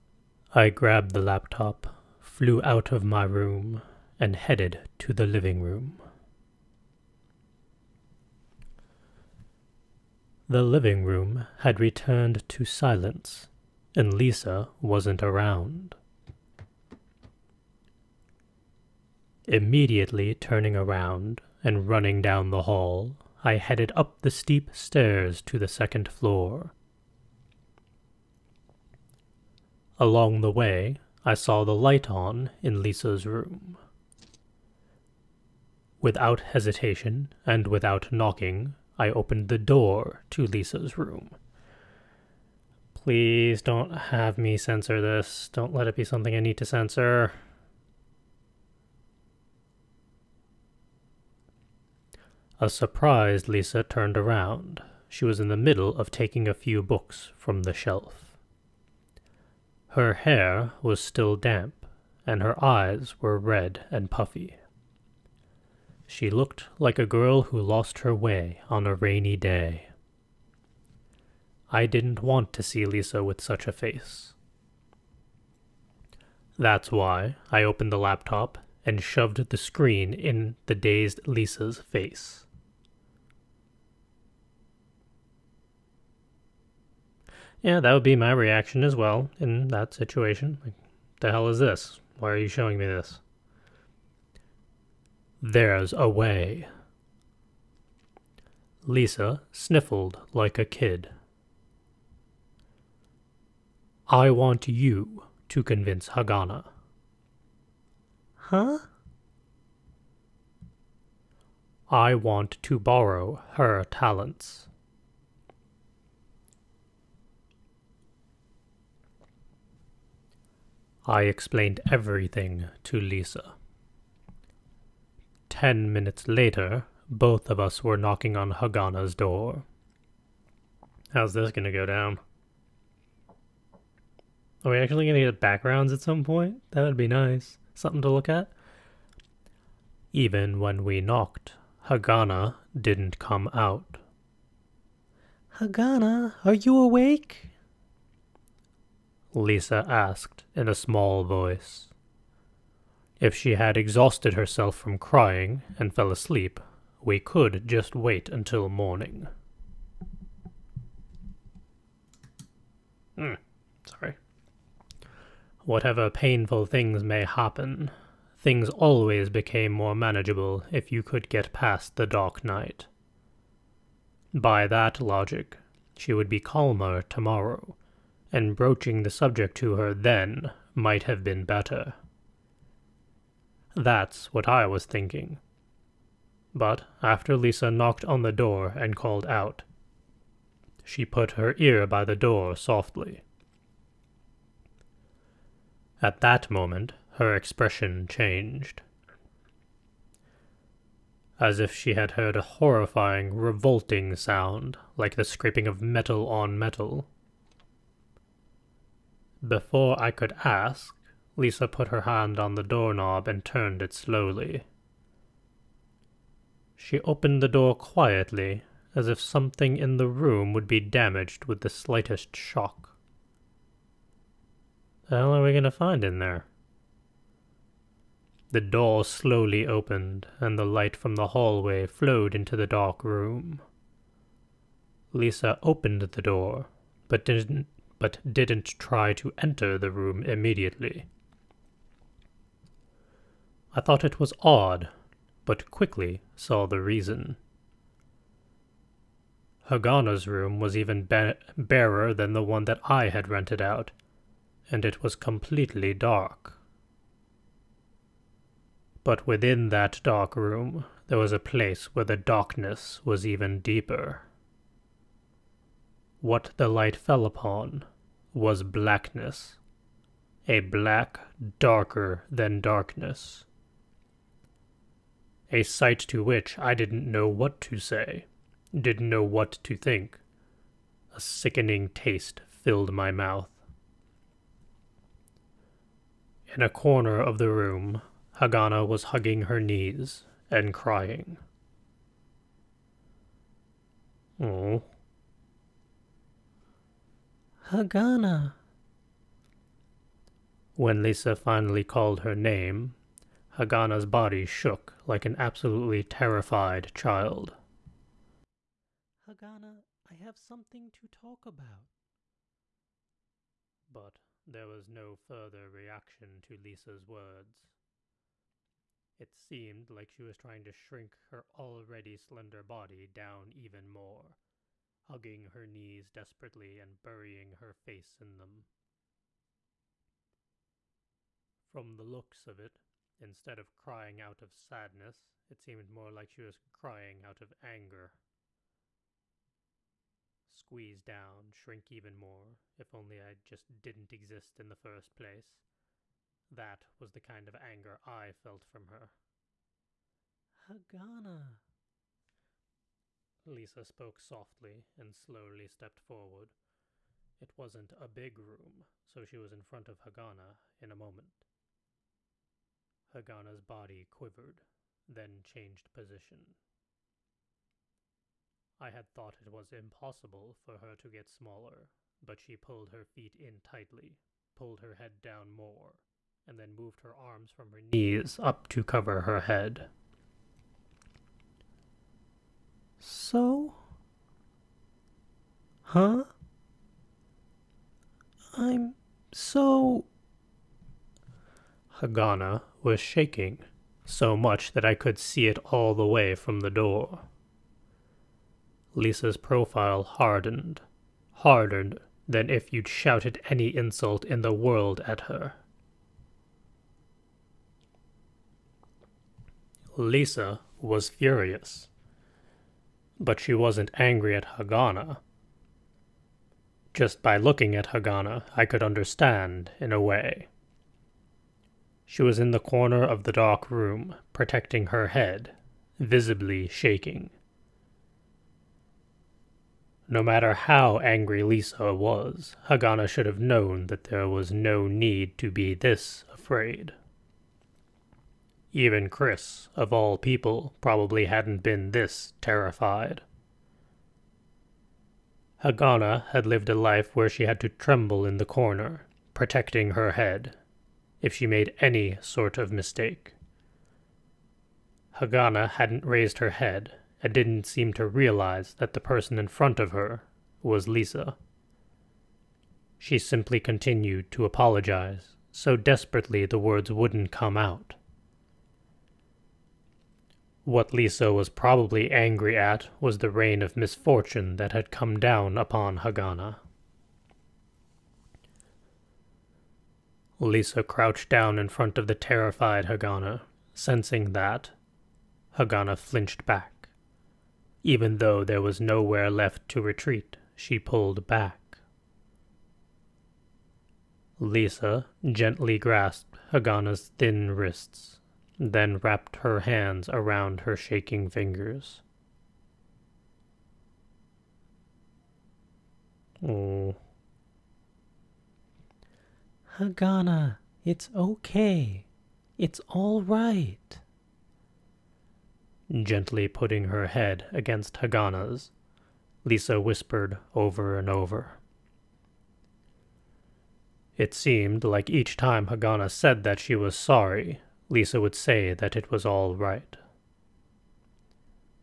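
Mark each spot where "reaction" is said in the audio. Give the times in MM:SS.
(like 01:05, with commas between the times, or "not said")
01:28, 05:15.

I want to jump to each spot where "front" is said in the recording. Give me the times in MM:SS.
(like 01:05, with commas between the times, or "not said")
05:59, 07:39, 08:01.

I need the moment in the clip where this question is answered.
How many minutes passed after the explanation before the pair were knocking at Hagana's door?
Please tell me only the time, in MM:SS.
02:05.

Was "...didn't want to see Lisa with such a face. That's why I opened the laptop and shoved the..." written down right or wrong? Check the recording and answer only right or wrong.
right.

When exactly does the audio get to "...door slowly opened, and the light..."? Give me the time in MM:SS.
03:48.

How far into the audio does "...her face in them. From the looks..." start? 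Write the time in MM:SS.
05:27.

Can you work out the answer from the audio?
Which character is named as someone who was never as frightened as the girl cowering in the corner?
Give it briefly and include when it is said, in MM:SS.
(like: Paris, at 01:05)
Chris, at 07:19.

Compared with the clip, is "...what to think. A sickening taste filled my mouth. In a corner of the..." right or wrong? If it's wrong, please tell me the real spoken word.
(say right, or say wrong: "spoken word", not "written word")
right.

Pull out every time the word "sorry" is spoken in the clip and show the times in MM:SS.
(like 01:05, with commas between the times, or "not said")
02:43, 08:46.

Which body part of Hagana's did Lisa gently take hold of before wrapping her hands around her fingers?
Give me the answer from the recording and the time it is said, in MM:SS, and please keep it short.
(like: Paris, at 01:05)
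wrists, at 08:17.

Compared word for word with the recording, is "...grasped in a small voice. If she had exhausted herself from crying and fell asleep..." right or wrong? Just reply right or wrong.
wrong.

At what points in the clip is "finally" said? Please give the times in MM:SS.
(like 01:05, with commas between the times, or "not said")
05:01.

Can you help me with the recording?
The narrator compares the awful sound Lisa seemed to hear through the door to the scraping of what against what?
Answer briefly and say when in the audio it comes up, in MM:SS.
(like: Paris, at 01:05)
metal on metal, at 03:25.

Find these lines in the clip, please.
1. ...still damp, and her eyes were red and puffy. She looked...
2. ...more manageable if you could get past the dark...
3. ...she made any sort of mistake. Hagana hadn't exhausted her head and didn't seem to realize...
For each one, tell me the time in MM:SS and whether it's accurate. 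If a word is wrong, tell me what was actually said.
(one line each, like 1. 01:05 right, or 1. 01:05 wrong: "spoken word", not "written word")
1. 01:00 right
2. 02:49 right
3. 07:31 wrong: "raised", not "exhausted".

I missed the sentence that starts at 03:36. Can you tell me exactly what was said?
She opened the door quietly, as if something in the room would be damaged with the slightest shock.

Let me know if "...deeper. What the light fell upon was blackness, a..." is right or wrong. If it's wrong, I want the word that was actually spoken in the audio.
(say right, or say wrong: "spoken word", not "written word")
right.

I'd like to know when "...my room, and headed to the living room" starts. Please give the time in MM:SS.
00:03.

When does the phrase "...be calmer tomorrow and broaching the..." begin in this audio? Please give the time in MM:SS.
02:56.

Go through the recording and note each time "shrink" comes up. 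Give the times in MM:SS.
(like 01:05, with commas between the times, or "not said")
05:20, 05:41.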